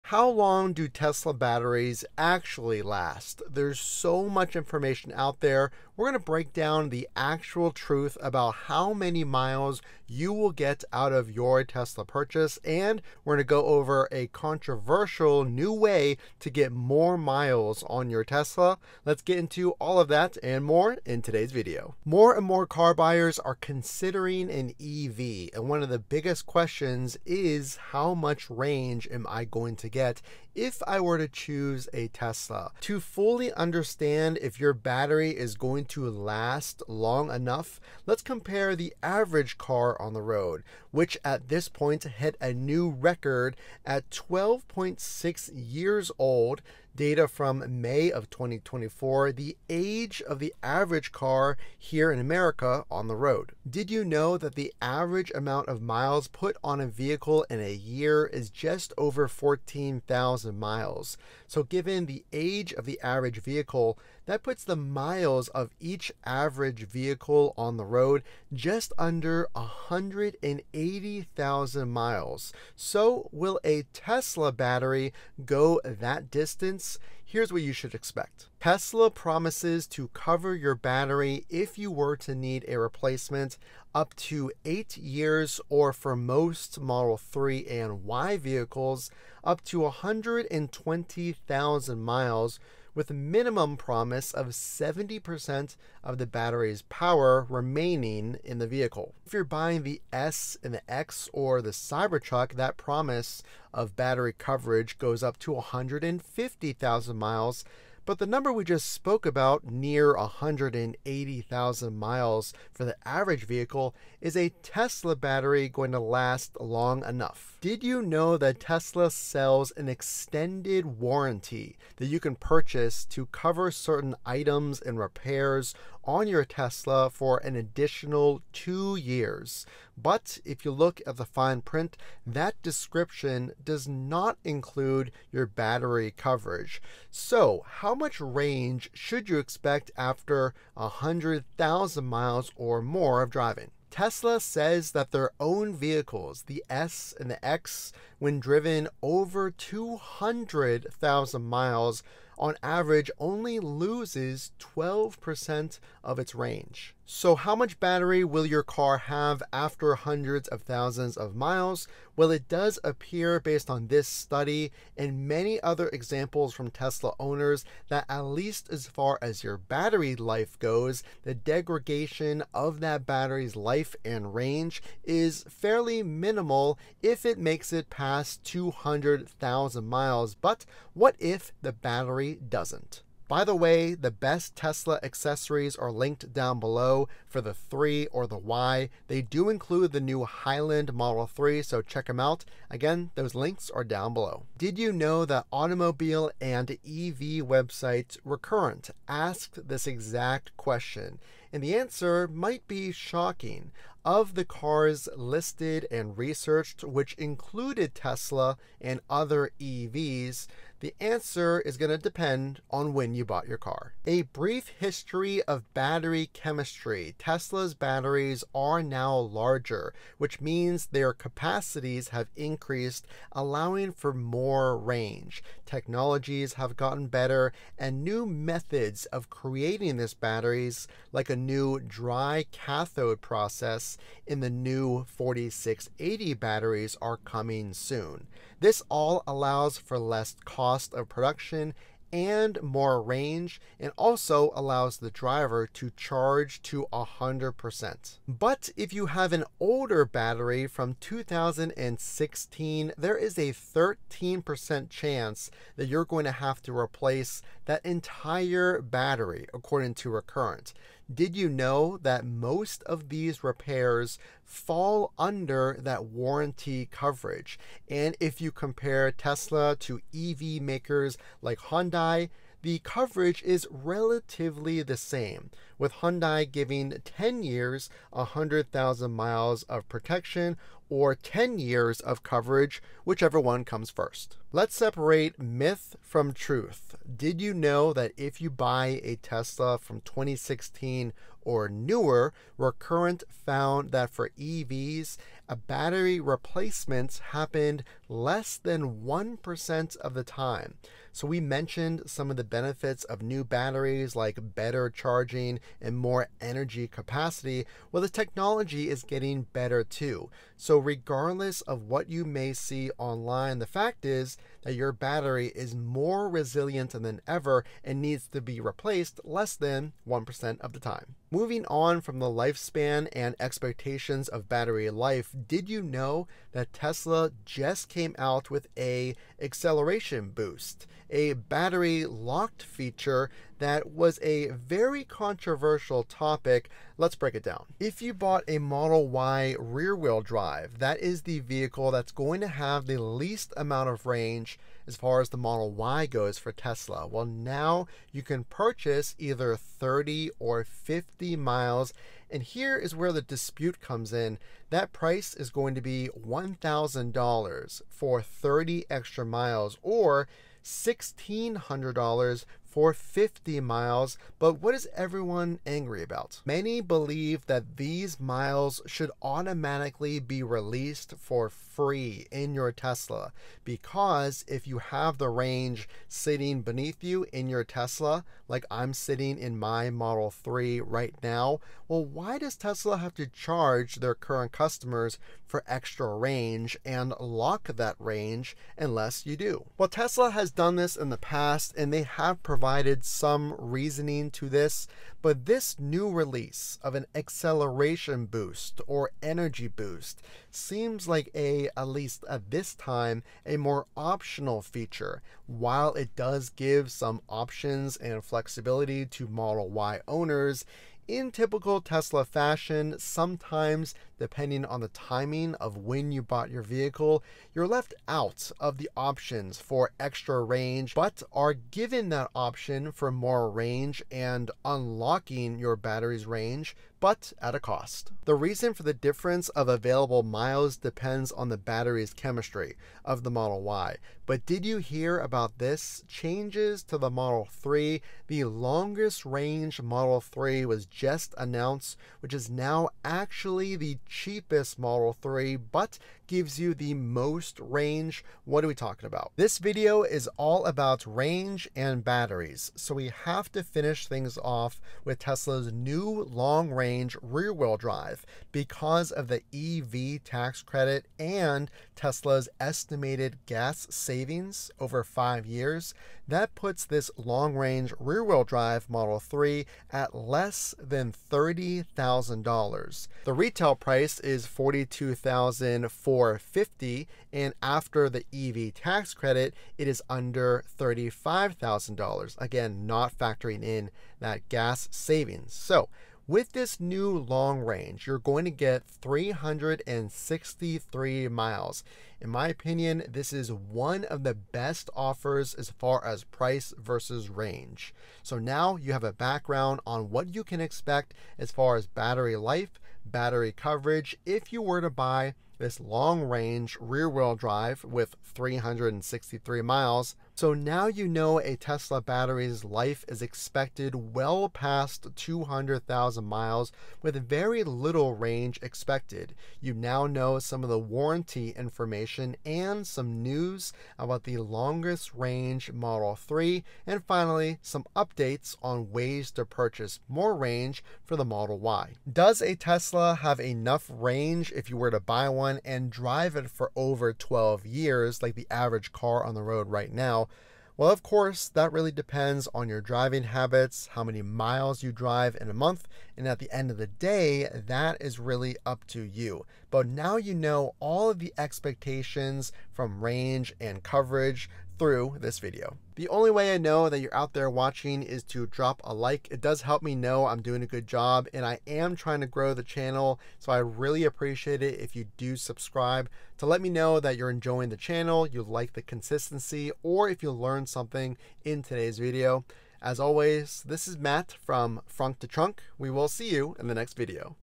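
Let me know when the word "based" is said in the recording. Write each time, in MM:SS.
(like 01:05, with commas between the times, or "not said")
02:43.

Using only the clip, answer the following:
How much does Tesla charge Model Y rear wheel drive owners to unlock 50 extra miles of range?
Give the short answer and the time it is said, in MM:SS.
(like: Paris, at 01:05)
$1,600, at 06:00.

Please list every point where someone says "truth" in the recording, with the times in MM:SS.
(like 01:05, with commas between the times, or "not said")
00:07, 04:46.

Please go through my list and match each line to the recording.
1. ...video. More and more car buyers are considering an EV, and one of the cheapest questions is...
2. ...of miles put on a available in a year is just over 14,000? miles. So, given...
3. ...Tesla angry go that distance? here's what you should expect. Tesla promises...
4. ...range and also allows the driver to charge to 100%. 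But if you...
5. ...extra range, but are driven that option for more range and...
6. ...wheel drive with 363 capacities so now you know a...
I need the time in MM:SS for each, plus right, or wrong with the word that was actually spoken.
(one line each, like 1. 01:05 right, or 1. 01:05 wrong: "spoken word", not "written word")
1. 00:21 wrong: "biggest", not "cheapest"
2. 00:55 wrong: "vehicle", not "available"
3. 01:13 wrong: "battery", not "angry"
4. 04:03 right
5. 06:59 wrong: "given", not "driven"
6. 08:27 wrong: "miles", not "capacities".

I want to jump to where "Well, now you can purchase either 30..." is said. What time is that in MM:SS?
05:47.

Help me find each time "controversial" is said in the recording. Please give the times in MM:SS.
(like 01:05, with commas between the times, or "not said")
00:14, 05:35.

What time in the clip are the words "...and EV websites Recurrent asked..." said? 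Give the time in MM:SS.
03:16.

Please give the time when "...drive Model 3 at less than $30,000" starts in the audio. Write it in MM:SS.
07:48.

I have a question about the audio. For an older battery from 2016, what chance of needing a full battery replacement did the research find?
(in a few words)
13%.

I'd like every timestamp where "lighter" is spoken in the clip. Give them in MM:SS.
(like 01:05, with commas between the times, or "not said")
not said.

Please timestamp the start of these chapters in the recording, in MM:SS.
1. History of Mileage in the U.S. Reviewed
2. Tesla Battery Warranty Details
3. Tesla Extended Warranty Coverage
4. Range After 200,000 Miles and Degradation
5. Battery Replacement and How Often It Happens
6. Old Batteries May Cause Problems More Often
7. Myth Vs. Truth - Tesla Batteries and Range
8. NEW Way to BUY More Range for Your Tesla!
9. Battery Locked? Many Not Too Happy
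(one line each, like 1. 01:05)
1. 00:33
2. 01:19
3. 01:57
4. 02:24
5. 03:15
6. 04:09
7. 04:45
8. 05:22
9. 06:07.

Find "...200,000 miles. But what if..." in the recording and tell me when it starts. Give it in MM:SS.
02:58.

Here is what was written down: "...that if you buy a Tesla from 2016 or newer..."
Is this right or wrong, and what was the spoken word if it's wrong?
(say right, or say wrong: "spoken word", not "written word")
right.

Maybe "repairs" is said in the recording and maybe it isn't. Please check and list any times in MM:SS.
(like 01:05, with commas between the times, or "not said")
02:04, 04:23.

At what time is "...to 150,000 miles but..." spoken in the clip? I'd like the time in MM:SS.
01:45.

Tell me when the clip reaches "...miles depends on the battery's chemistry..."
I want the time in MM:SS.
07:10.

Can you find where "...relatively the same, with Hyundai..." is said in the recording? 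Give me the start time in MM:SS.
04:33.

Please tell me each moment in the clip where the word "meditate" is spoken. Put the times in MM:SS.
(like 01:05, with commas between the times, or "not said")
not said.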